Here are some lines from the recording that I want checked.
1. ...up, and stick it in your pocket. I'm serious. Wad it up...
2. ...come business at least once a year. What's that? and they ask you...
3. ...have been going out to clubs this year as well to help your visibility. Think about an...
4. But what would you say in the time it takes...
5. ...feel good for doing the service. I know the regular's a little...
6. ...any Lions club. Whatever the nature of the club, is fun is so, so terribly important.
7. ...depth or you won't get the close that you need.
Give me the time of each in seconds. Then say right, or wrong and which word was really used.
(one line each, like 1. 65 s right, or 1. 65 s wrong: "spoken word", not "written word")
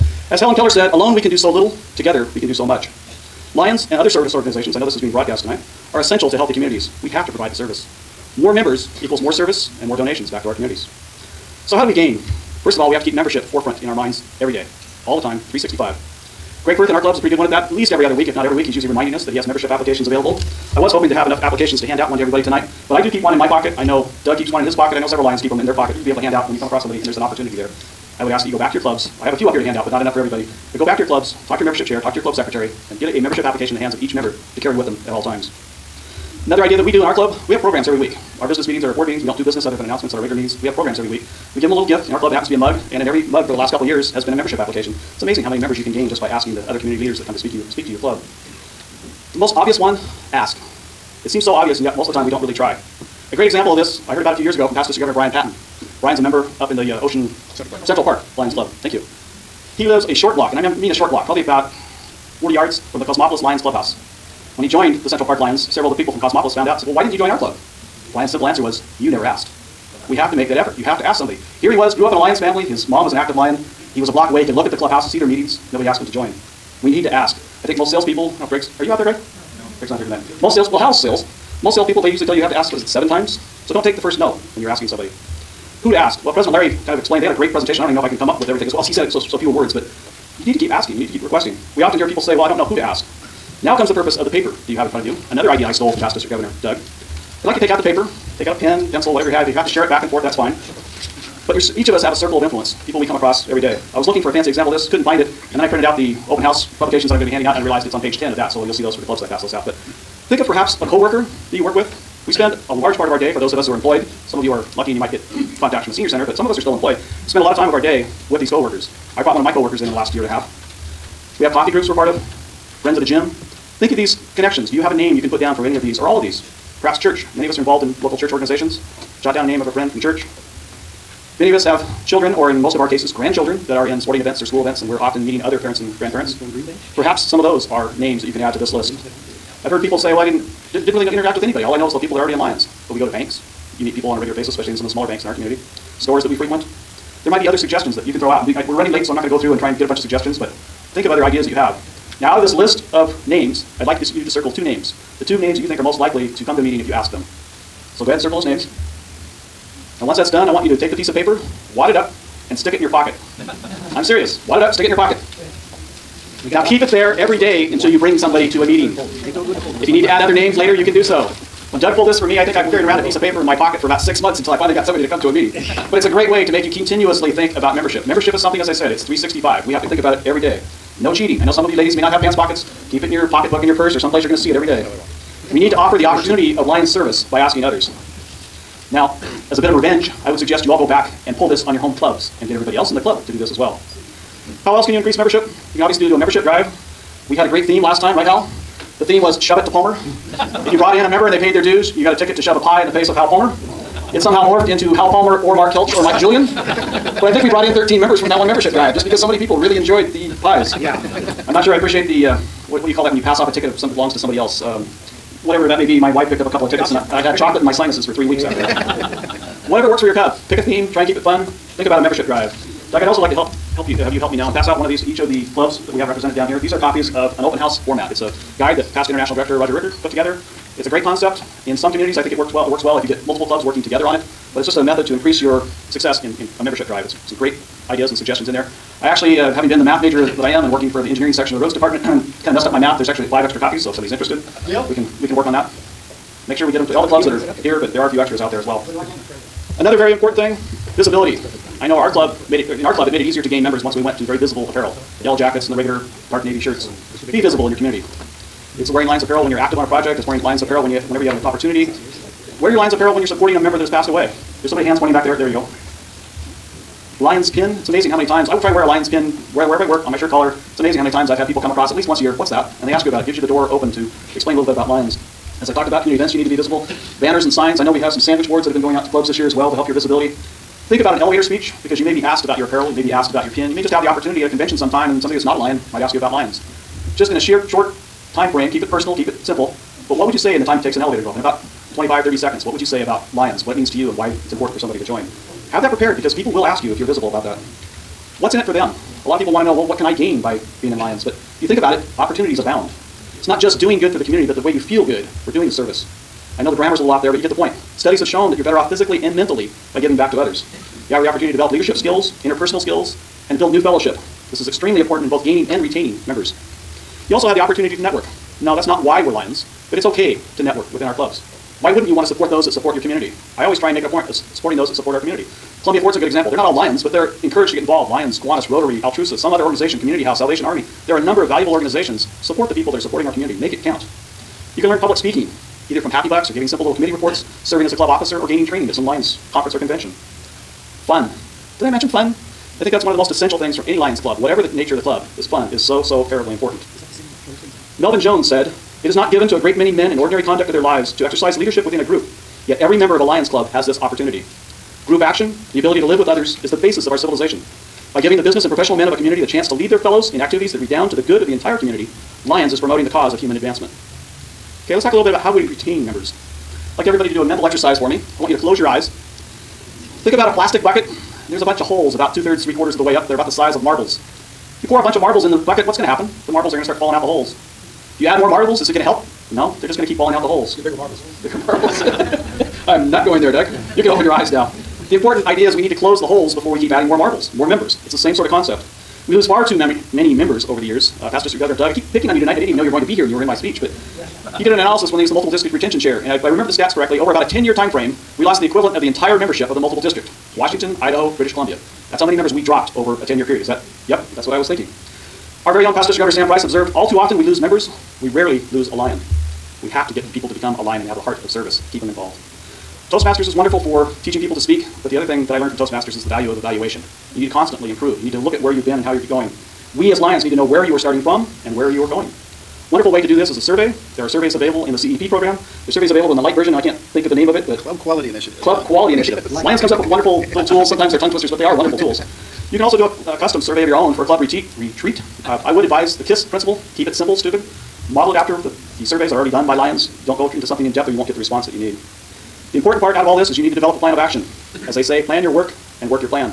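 1. 161 s right
2. 271 s wrong: "across", not "business"
3. 278 s right
4. 290 s right
5. 304 s wrong: "grammar", not "regular"
6. 343 s right
7. 440 s wrong: "response", not "close".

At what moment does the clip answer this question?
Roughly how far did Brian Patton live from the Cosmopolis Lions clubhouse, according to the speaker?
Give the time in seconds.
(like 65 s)
61 s.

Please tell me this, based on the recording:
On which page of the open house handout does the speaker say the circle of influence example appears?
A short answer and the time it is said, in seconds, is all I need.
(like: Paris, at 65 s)
page 10, at 107 s.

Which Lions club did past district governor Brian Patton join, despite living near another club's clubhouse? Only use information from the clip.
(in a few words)
Central Park Lions Club.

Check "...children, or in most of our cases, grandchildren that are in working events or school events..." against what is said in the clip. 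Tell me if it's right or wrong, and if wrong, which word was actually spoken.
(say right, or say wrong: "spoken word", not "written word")
wrong: "sporting", not "working".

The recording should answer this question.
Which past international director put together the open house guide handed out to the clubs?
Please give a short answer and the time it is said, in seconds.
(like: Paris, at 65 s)
Roger Rickard, at 229 s.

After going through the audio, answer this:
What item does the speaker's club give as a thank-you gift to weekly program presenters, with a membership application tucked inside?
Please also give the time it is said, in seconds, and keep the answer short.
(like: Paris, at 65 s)
a mug, at 42 s.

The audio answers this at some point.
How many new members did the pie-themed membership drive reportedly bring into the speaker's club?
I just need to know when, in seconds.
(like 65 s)
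207 s.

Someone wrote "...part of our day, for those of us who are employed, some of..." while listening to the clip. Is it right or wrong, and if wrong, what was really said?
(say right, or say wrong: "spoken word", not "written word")
right.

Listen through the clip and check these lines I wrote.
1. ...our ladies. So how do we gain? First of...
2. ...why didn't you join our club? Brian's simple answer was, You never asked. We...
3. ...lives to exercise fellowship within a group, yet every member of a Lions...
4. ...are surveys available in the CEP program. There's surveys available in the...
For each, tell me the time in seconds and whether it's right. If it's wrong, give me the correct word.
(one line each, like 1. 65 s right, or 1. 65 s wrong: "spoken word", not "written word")
1. 10 s wrong: "communities", not "ladies"
2. 66 s right
3. 350 s wrong: "leadership", not "fellowship"
4. 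424 s right.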